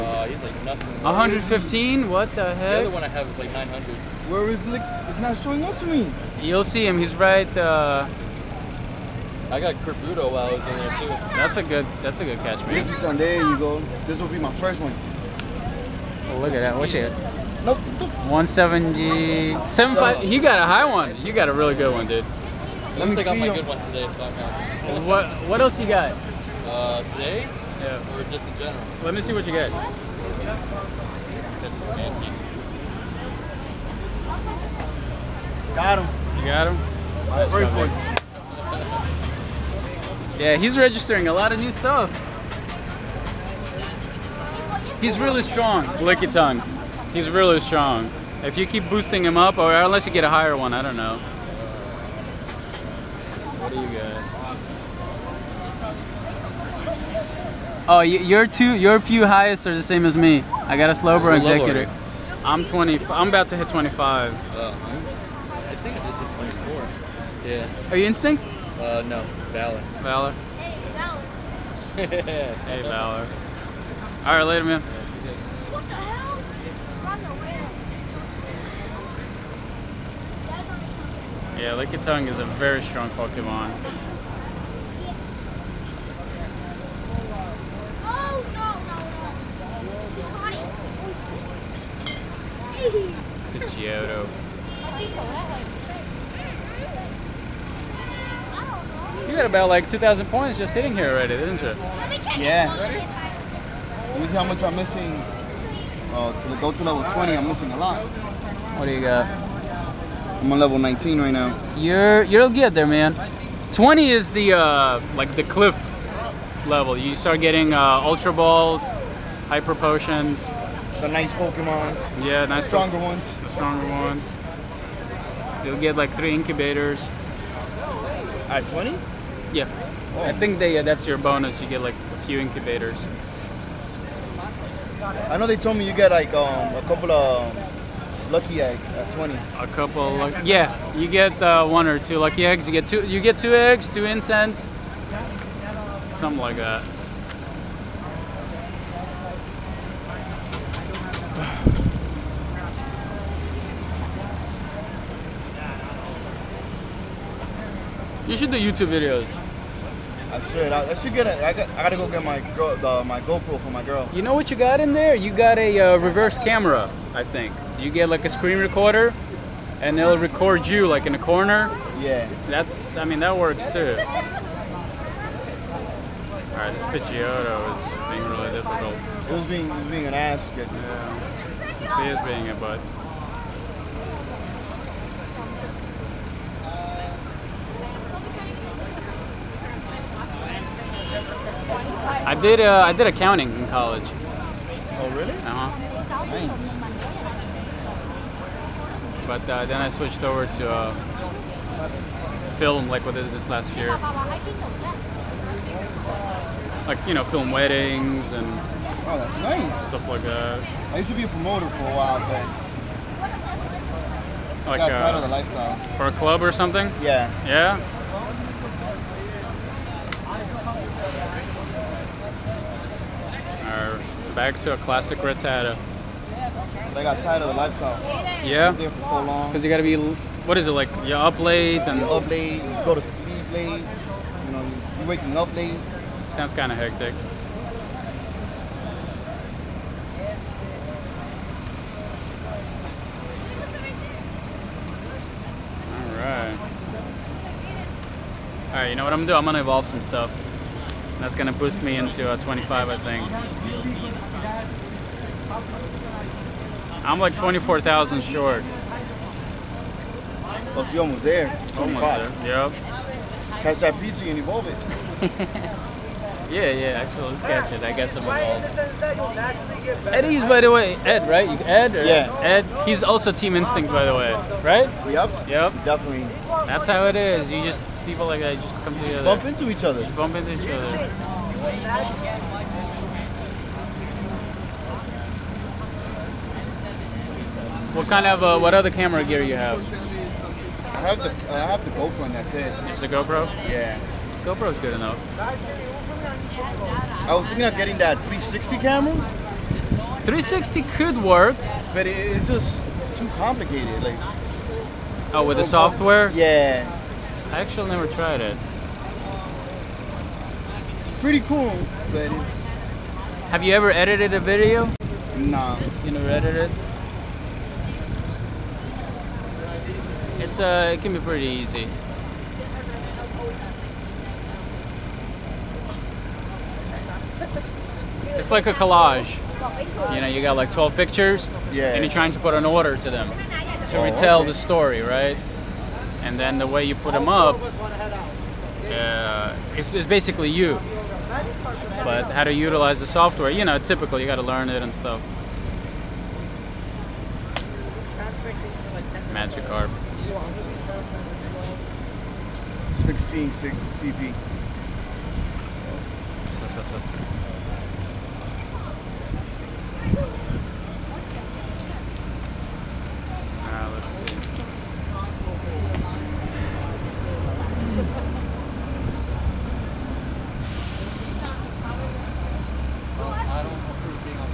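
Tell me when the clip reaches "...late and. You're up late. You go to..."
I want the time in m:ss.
3:51.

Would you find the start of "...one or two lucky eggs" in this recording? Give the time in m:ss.
2:21.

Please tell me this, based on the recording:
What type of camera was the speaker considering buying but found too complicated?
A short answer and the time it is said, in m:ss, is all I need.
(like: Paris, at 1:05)
360 camera, at 4:58.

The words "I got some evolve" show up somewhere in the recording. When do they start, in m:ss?
4:27.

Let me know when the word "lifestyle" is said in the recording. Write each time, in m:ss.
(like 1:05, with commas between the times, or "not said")
3:35, 3:47.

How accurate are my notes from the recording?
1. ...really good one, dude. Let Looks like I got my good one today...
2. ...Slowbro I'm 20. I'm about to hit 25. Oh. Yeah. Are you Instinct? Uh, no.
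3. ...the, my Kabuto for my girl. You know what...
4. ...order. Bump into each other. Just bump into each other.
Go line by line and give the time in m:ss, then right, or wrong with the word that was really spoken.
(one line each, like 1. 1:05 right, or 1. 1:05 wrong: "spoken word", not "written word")
1. 0:21 right
2. 1:00 right
3. 2:42 wrong: "GoPro", not "Kabuto"
4. 4:38 wrong: "together", not "order".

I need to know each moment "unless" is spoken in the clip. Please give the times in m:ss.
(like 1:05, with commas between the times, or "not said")
0:49.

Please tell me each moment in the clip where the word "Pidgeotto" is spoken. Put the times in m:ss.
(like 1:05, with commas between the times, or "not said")
1:33, 2:56.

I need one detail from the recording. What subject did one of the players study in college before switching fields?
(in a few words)
Accounting.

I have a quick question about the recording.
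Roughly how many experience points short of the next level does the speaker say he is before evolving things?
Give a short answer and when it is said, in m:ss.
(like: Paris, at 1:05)
24,000, at 4:17.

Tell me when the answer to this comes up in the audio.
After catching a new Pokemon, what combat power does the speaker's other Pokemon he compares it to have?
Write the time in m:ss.
0:03.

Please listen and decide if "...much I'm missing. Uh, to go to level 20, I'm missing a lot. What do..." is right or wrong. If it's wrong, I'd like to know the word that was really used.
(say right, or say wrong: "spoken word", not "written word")
right.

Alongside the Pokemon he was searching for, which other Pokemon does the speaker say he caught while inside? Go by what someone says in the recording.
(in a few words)
Kabuto.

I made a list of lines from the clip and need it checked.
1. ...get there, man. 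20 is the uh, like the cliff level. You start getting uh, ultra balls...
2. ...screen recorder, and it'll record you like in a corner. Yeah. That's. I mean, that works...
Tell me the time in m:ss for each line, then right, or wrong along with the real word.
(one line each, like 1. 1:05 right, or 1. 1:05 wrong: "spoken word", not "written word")
1. 1:52 right
2. 2:48 right.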